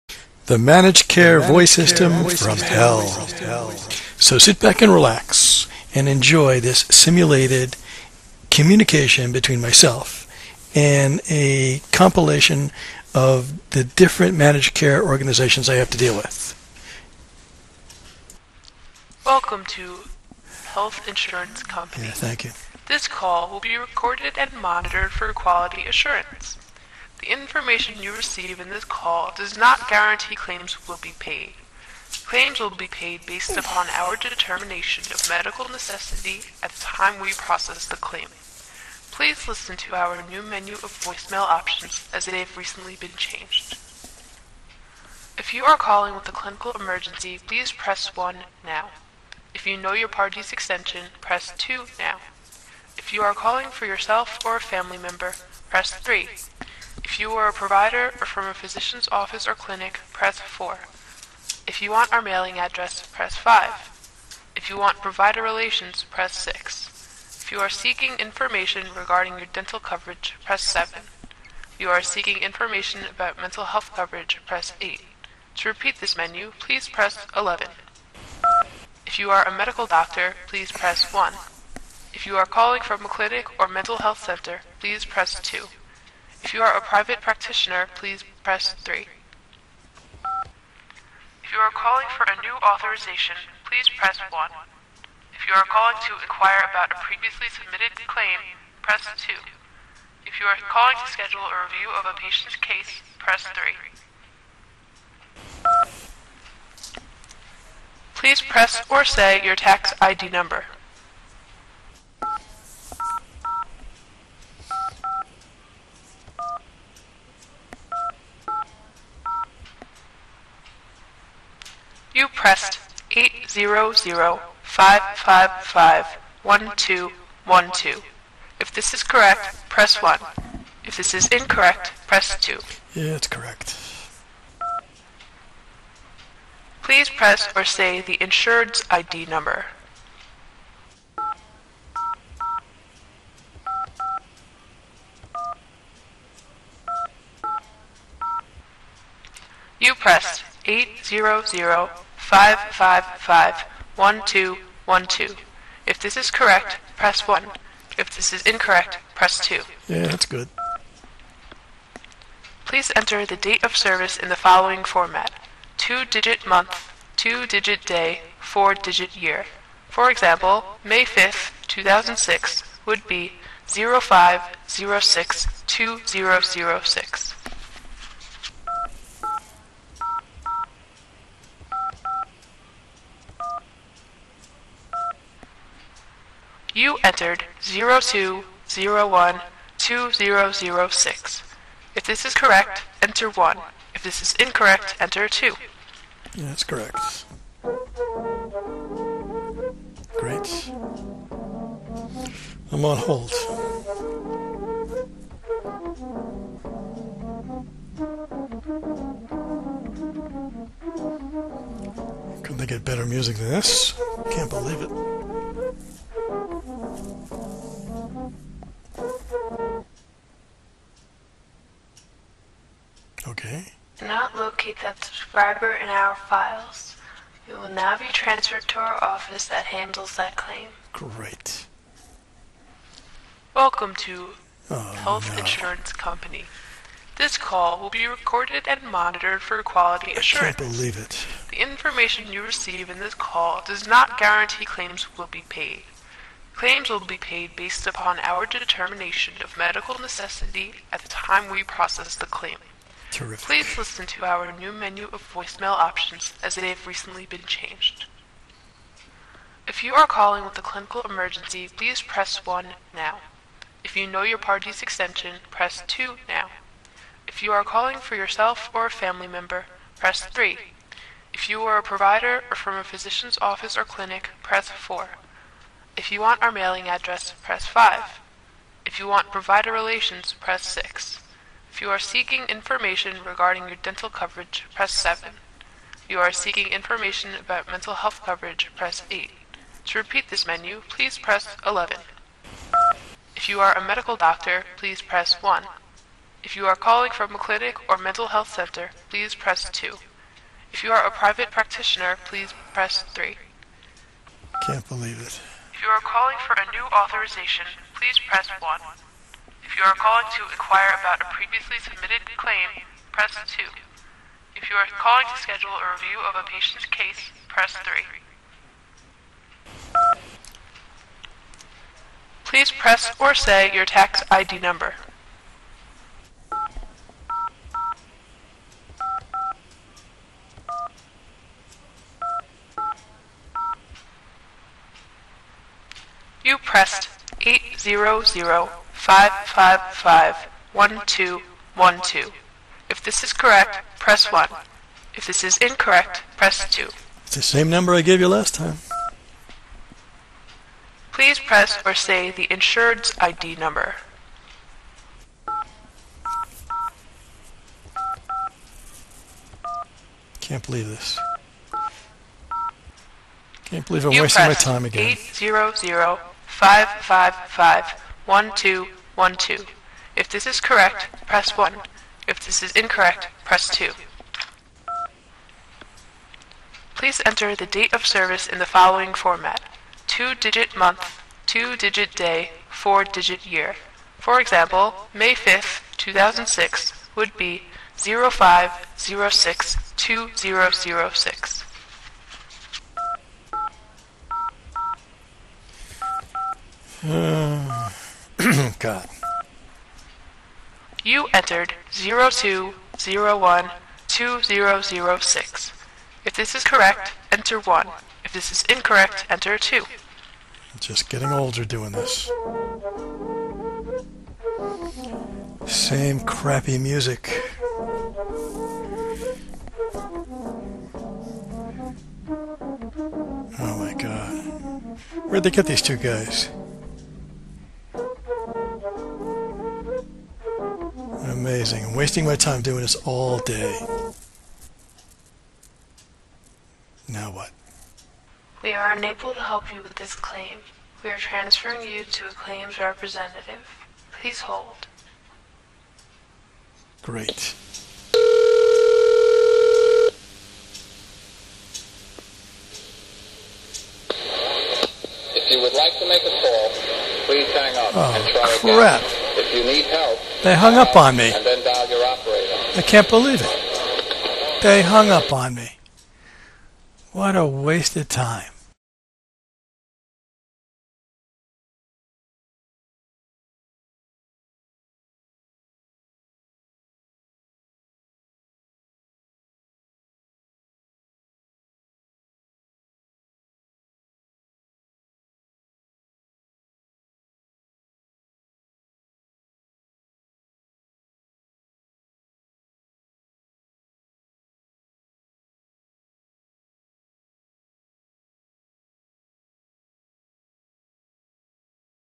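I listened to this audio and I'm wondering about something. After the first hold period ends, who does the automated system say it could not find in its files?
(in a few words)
that subscriber.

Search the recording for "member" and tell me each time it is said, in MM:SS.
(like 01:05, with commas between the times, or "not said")
00:54, 04:29.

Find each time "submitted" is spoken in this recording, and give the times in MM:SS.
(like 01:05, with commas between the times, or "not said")
01:37, 05:11.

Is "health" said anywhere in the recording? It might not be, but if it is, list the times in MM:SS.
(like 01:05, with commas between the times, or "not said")
00:20, 01:13, 01:23, 03:54, 04:47, 04:58.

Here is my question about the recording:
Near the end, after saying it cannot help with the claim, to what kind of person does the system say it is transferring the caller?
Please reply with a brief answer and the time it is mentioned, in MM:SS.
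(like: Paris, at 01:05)
claims representative, at 07:22.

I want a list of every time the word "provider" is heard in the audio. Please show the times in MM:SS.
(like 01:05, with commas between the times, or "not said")
00:57, 01:05, 04:31, 04:39.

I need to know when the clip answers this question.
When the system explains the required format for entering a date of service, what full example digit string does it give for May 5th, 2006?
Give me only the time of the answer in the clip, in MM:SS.
02:53.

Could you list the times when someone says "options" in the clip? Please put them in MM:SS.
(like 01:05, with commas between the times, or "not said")
00:41, 04:15.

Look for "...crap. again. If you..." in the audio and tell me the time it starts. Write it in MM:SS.
07:38.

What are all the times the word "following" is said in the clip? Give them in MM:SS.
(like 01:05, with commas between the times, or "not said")
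02:44, 06:18.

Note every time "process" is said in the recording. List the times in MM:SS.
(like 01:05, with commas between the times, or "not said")
00:37, 04:11.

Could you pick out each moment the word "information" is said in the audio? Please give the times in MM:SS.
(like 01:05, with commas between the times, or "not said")
00:27, 01:08, 01:12, 04:01, 04:42, 04:46.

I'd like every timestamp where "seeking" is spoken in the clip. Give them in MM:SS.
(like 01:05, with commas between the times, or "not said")
01:07, 01:12, 04:41, 04:46.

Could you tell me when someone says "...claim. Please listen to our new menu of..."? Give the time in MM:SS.
00:37.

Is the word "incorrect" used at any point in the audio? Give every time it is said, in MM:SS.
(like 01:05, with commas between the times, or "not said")
02:11, 02:38, 03:14, 05:45, 06:12, 06:48.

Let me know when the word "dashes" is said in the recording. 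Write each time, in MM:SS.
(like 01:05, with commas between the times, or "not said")
not said.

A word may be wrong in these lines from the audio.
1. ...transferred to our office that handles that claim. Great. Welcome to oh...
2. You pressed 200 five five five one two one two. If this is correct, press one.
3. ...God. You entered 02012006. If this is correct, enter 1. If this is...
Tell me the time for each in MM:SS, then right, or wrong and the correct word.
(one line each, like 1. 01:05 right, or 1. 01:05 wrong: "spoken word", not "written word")
1. 03:48 right
2. 05:36 wrong: "800", not "200"
3. 06:38 right.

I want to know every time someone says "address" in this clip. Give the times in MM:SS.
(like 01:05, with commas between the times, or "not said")
01:02, 04:36.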